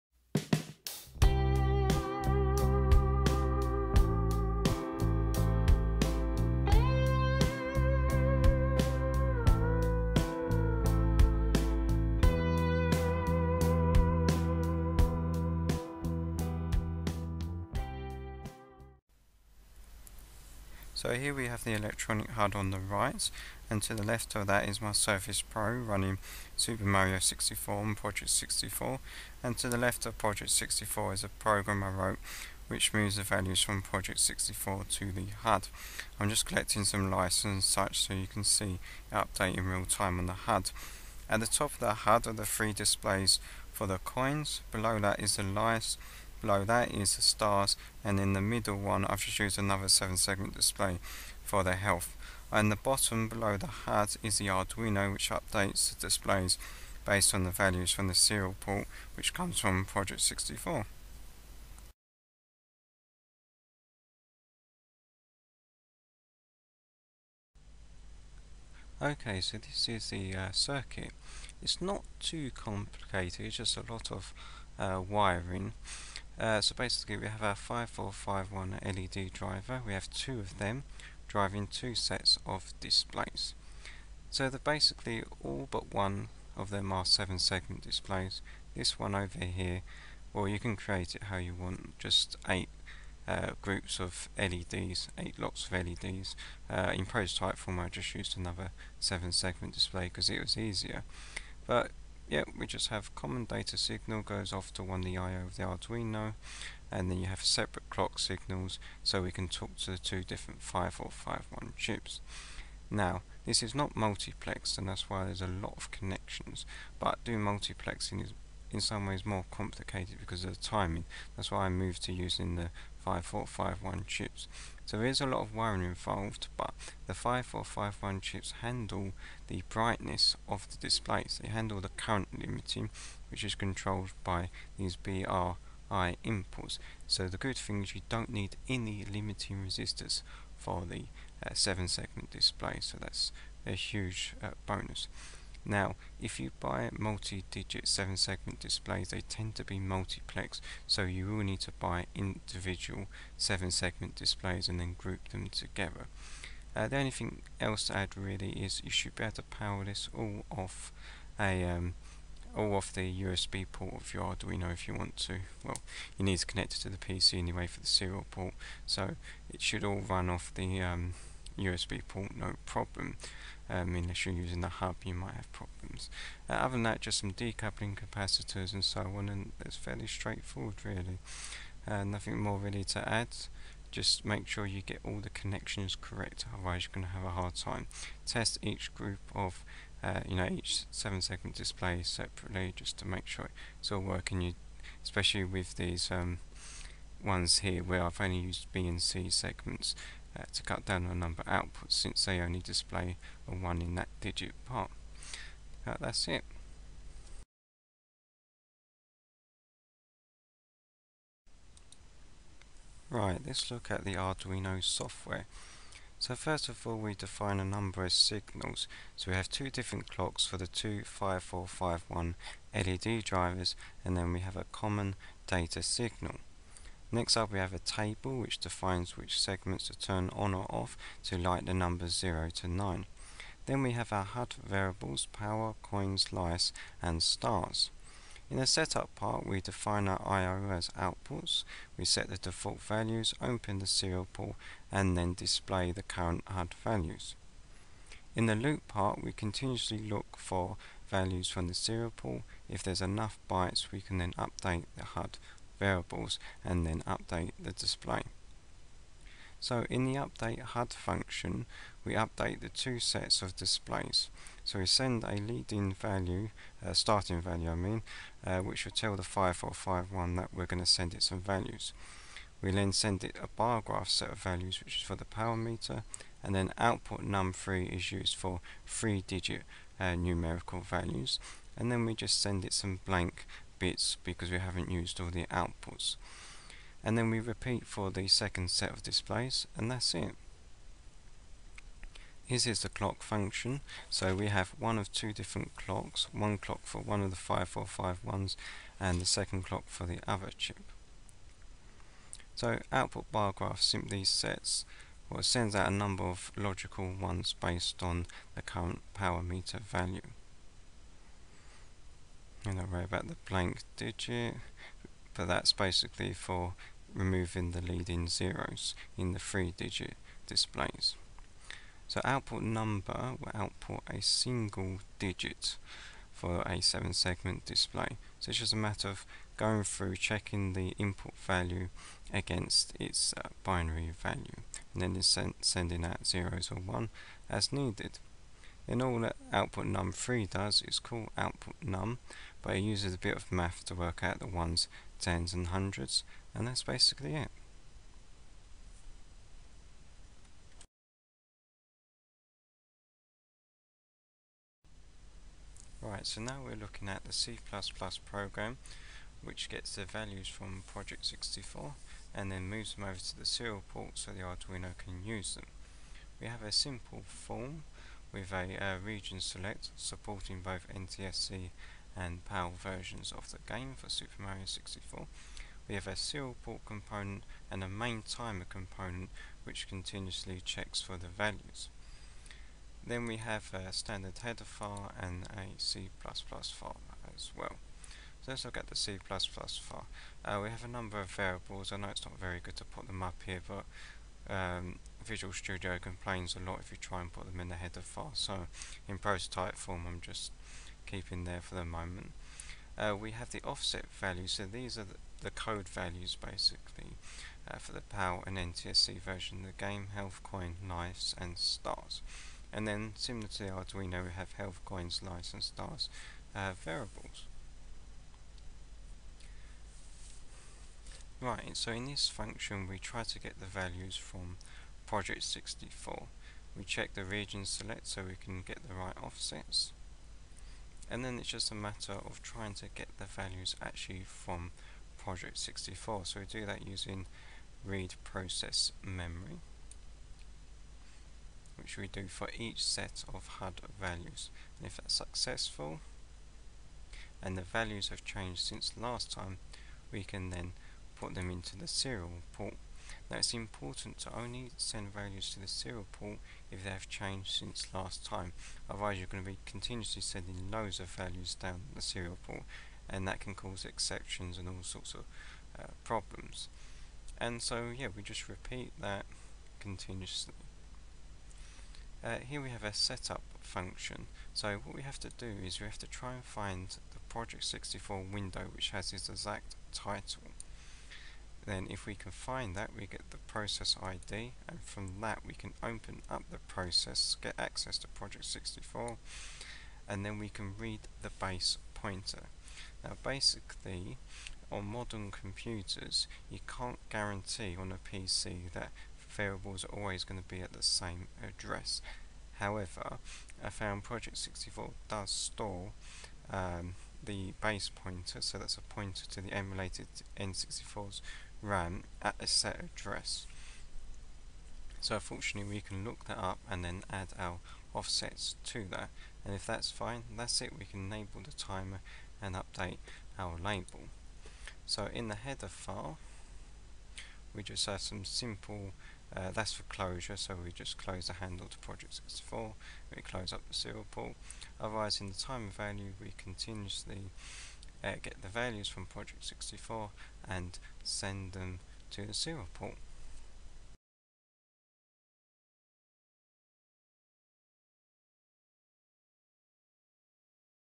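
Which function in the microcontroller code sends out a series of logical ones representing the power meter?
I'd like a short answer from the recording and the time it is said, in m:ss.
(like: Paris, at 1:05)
output bar graph, at 5:02.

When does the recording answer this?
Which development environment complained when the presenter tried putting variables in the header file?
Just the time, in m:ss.
6:35.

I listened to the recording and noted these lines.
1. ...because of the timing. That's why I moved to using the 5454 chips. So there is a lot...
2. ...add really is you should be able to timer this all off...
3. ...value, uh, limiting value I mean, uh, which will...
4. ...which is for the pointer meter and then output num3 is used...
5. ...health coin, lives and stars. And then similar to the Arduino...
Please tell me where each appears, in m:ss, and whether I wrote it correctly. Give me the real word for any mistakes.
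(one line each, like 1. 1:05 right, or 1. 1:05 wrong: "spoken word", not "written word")
1. 2:00 wrong: "5451", not "5454"
2. 2:37 wrong: "power", not "timer"
3. 4:25 wrong: "starting", not "limiting"
4. 4:34 wrong: "power", not "pointer"
5. 6:50 right.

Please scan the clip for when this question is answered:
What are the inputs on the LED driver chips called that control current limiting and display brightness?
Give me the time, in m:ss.
2:14.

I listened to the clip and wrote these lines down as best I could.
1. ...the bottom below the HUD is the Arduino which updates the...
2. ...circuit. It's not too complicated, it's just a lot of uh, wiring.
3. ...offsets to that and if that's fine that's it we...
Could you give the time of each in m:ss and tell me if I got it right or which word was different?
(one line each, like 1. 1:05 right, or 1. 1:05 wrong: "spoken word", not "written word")
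1. 0:52 right
2. 1:10 right
3. 8:37 right.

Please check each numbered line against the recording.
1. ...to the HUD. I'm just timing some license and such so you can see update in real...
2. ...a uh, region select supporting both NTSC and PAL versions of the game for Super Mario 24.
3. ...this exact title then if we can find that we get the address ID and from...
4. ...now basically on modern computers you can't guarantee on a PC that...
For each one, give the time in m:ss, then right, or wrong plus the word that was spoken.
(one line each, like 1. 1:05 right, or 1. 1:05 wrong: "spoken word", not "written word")
1. 0:34 wrong: "collecting", not "timing"
2. 6:08 wrong: "64", not "24"
3. 7:59 wrong: "process", not "address"
4. 8:13 right.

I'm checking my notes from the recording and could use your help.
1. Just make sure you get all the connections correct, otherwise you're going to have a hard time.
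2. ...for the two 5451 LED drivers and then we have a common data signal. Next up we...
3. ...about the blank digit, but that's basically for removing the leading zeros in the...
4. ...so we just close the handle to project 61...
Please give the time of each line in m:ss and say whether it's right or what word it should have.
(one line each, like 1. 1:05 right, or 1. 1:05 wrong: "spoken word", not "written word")
1. 3:03 right
2. 3:40 right
3. 5:13 right
4. 8:50 wrong: "64", not "61".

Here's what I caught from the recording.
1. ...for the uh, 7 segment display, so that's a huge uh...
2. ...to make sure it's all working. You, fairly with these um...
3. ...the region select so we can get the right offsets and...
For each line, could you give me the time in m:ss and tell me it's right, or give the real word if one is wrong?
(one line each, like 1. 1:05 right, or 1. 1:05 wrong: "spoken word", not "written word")
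1. 2:20 right
2. 3:12 wrong: "especially", not "fairly"
3. 7:07 right.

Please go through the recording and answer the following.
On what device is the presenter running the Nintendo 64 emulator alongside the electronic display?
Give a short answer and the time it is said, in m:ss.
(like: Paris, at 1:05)
Surface Pro, at 0:24.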